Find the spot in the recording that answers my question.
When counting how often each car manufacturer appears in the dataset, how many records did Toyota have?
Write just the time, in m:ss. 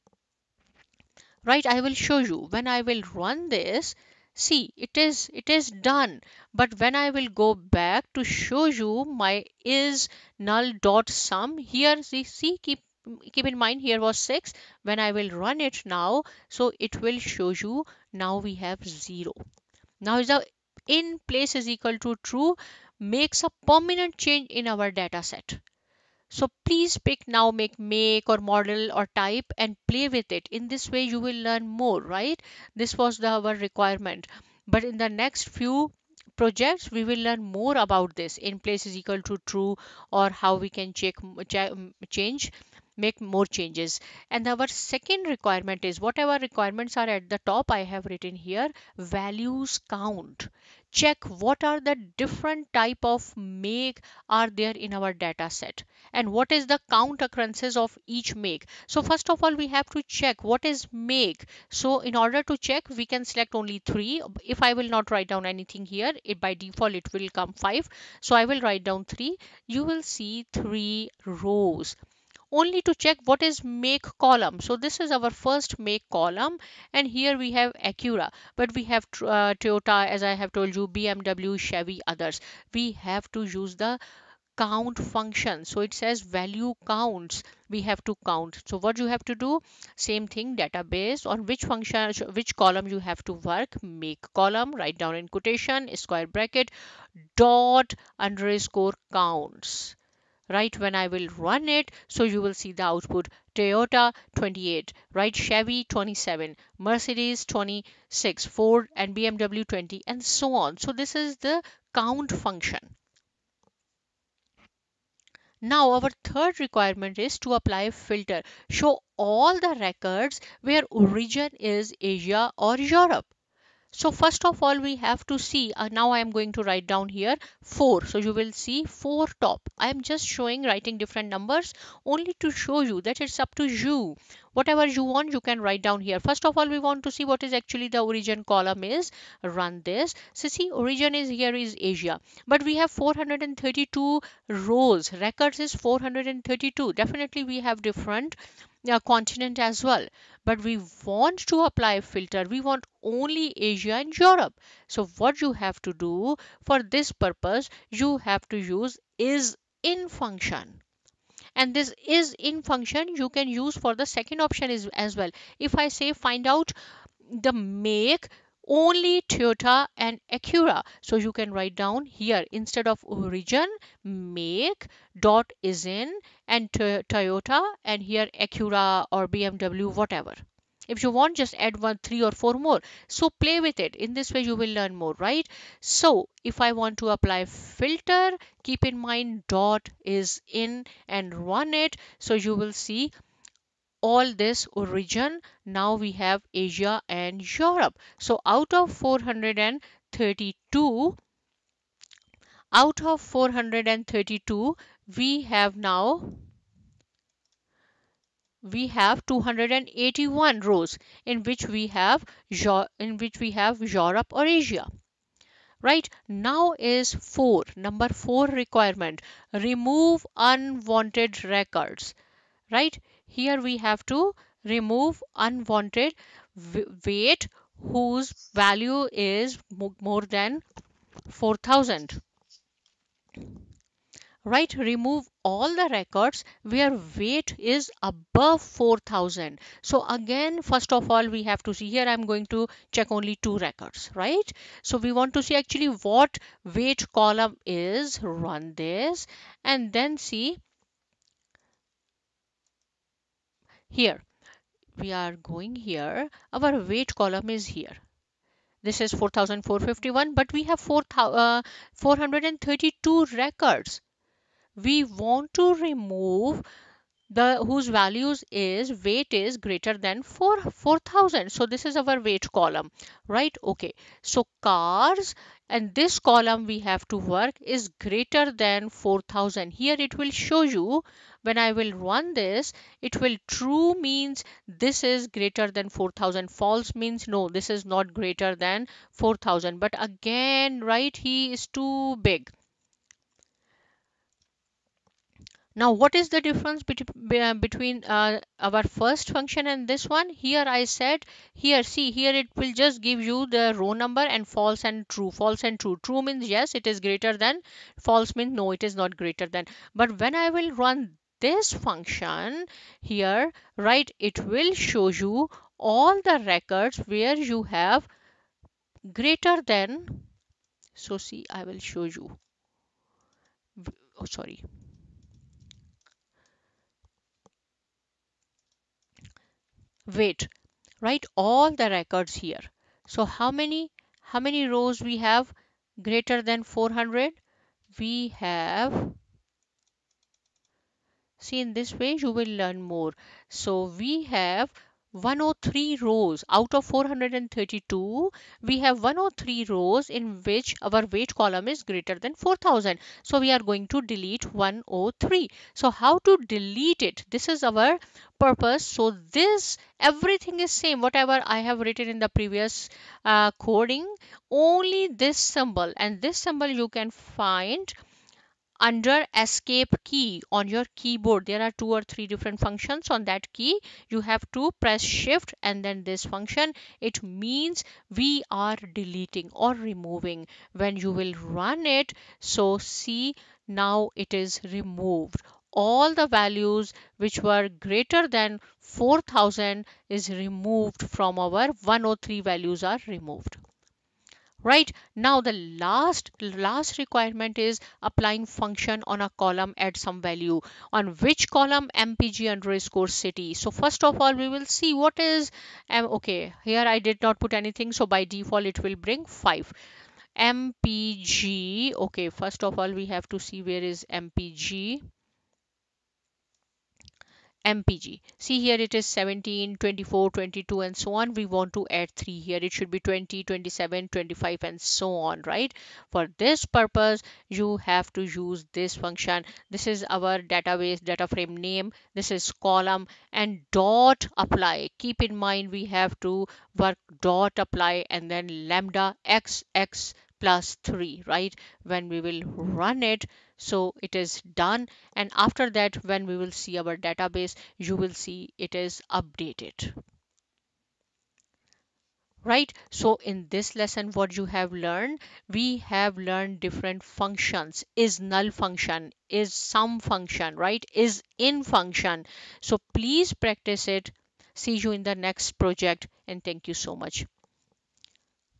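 1:43.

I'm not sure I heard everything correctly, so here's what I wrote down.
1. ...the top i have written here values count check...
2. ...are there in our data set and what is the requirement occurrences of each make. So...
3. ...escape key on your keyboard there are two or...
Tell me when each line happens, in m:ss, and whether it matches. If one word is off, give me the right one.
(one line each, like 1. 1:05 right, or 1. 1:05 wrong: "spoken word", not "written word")
1. 0:47 right
2. 0:54 wrong: "count", not "requirement"
3. 6:09 right.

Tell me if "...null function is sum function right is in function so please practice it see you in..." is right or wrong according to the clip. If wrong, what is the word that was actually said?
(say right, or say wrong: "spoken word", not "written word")
right.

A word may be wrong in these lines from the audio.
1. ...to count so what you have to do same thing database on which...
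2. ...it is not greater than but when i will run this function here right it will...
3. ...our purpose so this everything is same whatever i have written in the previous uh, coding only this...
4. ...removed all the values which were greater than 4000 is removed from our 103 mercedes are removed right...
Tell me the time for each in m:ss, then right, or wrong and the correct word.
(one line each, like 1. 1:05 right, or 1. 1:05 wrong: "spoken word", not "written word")
1. 1:28 right
2. 5:08 right
3. 5:57 right
4. 6:24 wrong: "values", not "mercedes".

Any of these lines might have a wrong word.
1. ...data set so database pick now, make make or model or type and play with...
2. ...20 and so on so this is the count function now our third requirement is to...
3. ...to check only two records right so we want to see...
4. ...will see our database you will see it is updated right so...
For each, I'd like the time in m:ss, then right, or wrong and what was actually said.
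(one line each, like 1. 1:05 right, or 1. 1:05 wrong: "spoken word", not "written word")
1. 0:24 wrong: "please", not "database"
2. 1:49 right
3. 4:02 right
4. 7:26 right.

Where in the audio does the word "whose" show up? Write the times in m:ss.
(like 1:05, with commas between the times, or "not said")
3:47, 4:27.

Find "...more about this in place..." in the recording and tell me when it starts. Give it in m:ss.
0:37.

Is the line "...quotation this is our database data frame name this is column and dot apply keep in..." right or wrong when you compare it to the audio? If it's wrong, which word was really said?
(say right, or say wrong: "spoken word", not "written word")
wrong: "function", not "quotation".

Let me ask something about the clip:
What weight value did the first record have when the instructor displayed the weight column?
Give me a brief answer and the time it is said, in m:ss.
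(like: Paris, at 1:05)
4451, at 4:19.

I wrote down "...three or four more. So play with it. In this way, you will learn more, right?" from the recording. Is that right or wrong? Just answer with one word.
right.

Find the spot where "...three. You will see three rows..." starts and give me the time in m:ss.
1:09.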